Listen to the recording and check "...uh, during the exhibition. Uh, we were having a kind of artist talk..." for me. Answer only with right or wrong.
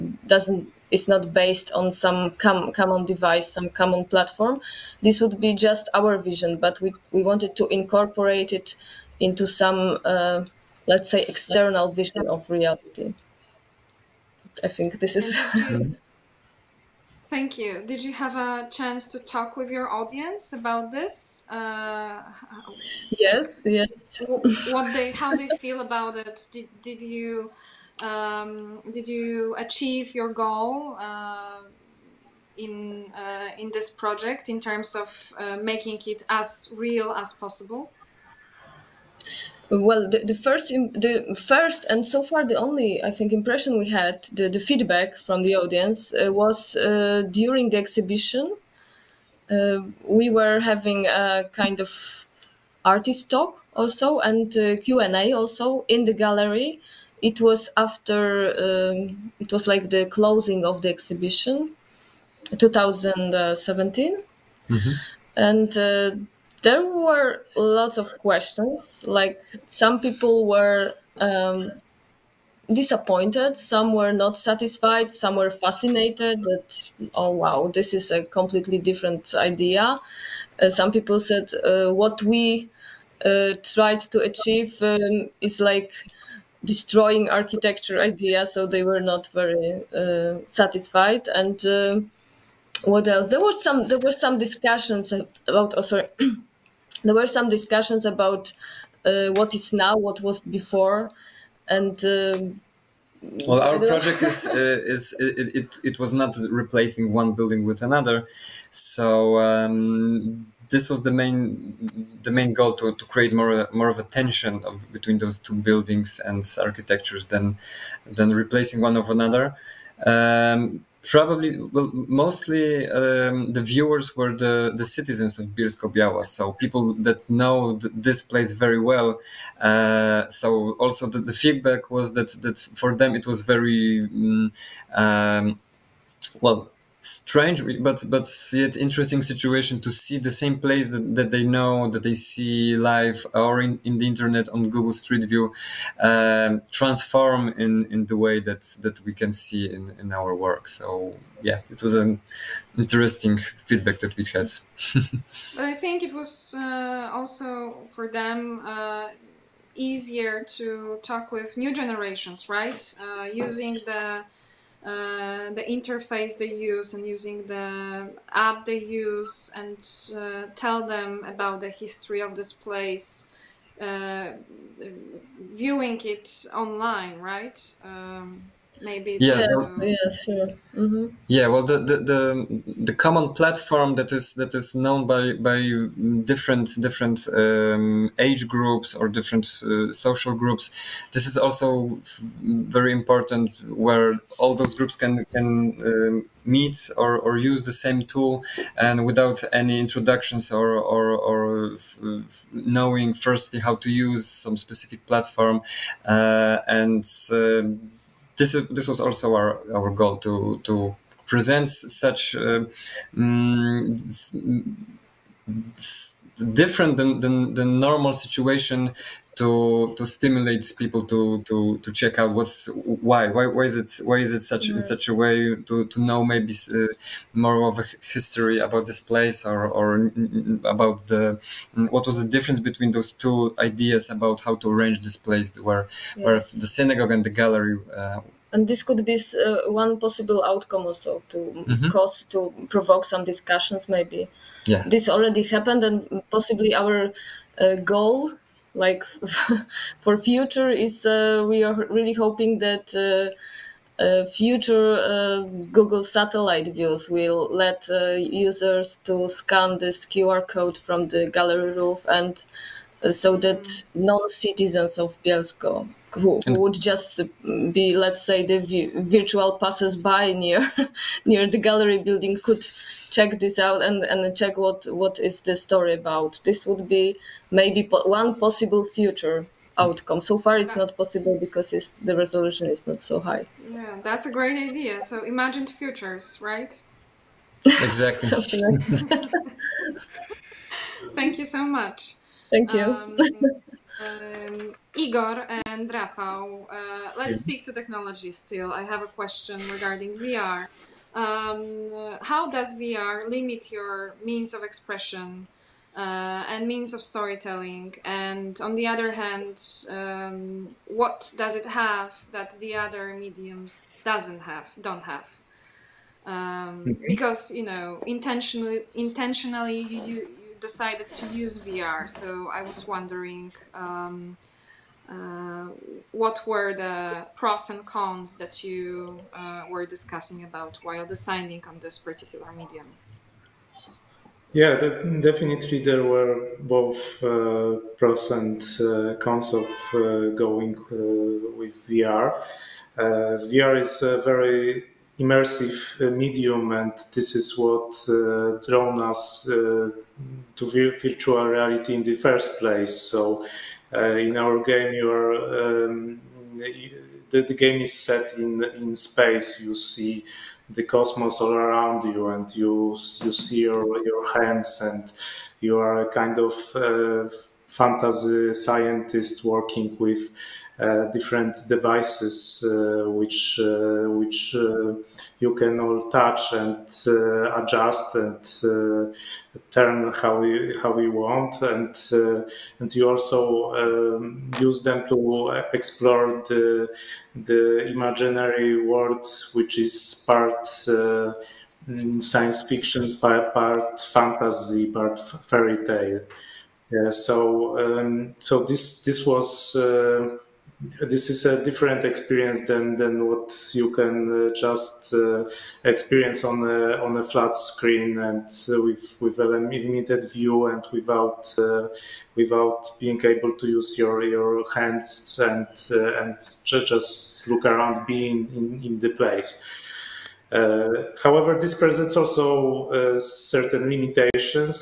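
right.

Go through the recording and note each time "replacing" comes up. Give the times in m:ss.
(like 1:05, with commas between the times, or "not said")
1:46, 1:58.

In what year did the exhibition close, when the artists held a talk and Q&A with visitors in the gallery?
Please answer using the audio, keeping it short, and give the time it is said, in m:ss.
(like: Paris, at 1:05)
2017, at 1:02.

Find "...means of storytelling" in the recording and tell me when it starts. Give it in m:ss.
5:06.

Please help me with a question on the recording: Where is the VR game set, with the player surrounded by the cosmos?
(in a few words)
Space.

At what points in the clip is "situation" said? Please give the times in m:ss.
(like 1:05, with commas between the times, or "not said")
2:19, 3:38.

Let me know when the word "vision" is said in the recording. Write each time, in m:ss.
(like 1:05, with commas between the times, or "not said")
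0:06, 0:11.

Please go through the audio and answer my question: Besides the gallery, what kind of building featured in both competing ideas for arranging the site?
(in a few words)
Synagogue.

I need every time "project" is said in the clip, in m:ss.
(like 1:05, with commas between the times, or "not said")
0:33, 1:43.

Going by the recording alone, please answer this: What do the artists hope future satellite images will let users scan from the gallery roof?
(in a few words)
QR code.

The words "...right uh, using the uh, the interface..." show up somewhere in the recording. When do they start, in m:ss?
2:42.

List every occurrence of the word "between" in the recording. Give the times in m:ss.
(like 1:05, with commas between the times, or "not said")
1:54, 3:52.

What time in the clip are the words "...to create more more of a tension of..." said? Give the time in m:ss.
1:52.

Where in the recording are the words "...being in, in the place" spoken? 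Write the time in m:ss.
6:58.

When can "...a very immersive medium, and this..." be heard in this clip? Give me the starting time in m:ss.
5:44.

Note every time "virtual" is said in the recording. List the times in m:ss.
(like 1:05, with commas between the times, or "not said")
4:28, 5:51.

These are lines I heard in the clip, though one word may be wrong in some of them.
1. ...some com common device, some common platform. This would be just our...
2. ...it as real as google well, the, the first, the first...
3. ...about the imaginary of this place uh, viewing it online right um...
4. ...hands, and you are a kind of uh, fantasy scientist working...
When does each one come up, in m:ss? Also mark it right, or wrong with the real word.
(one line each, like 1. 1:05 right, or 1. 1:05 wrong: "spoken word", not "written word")
1. 0:01 right
2. 0:36 wrong: "possible", not "google"
3. 2:51 wrong: "history", not "imaginary"
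4. 6:04 right.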